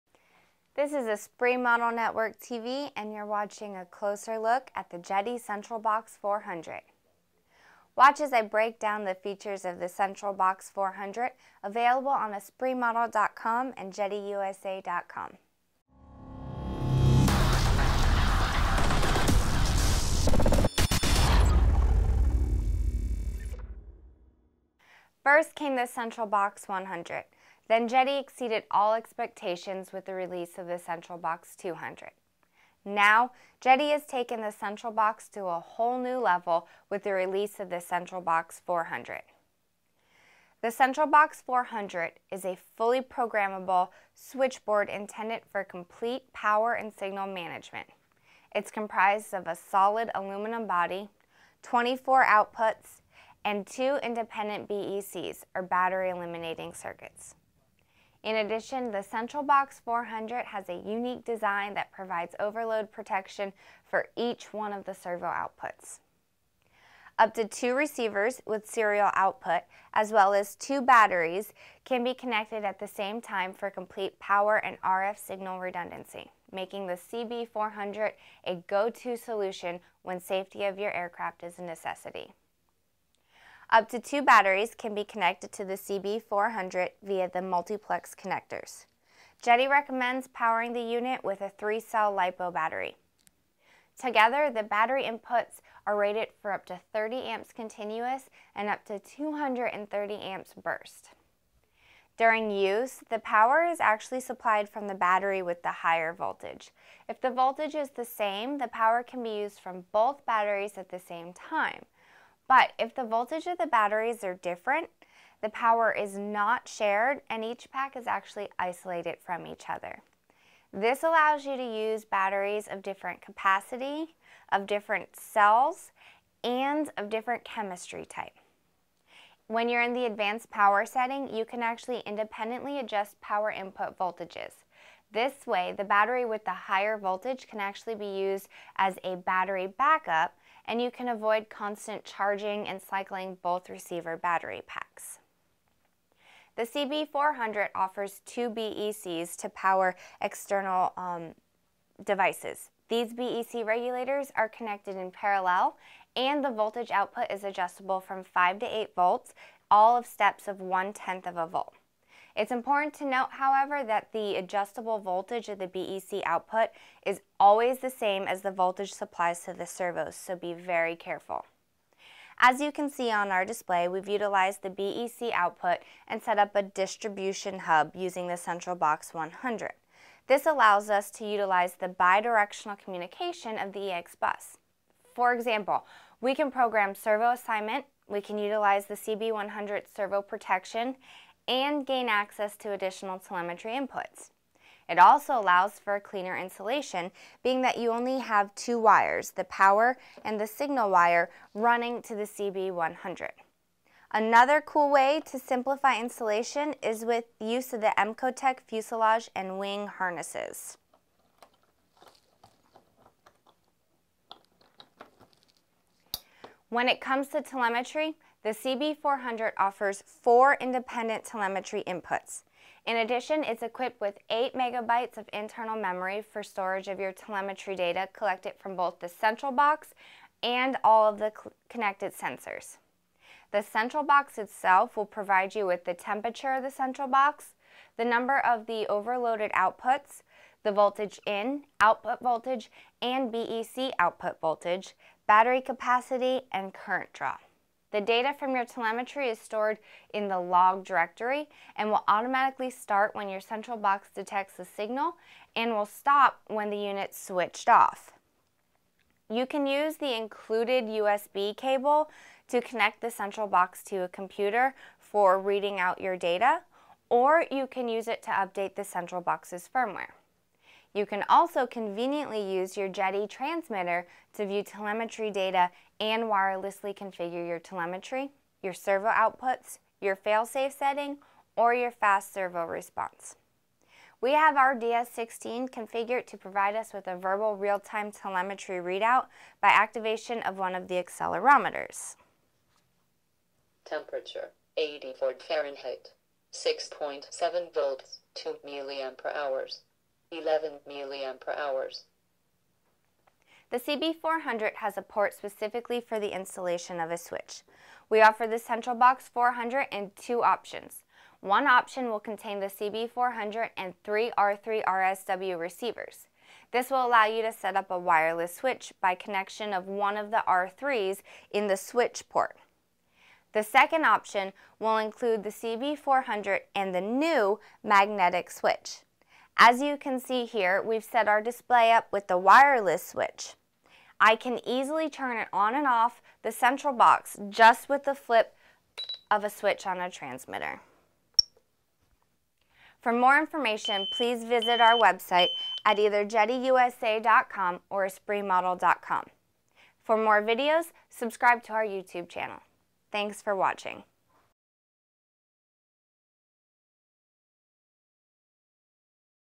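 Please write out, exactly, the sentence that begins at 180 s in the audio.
This allows us to utilize the bidirectional communication of the EX bus.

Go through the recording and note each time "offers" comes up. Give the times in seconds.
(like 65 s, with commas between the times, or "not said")
147 s, 219 s, 308 s.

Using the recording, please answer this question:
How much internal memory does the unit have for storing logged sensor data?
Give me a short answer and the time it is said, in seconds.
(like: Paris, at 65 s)
8 megabytes, at 224 s.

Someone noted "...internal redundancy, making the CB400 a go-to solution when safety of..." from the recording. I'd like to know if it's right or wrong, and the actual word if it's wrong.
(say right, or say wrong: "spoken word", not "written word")
wrong: "signal", not "internal".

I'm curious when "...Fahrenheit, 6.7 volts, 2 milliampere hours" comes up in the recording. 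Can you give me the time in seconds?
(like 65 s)
295 s.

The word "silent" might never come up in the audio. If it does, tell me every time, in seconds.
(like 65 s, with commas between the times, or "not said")
not said.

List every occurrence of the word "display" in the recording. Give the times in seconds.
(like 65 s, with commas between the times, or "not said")
173 s, 331 s.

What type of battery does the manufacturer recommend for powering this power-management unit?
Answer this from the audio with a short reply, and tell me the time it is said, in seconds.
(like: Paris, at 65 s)
3-cell LiPo, at 91 s.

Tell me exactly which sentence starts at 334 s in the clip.
I can easily turn it on and off the central box just with the flip of a switch on a transmitter.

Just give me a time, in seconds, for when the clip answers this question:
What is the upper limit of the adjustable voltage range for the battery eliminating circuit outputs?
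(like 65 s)
158 s.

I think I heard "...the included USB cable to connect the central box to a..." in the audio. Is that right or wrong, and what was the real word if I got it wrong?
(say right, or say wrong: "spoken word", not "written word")
right.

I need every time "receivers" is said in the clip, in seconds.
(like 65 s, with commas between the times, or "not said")
67 s, 143 s, 315 s.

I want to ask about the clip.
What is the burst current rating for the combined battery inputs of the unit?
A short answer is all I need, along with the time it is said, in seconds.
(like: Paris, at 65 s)
230 amps, at 98 s.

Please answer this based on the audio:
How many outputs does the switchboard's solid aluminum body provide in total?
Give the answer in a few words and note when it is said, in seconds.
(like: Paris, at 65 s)
24, at 51 s.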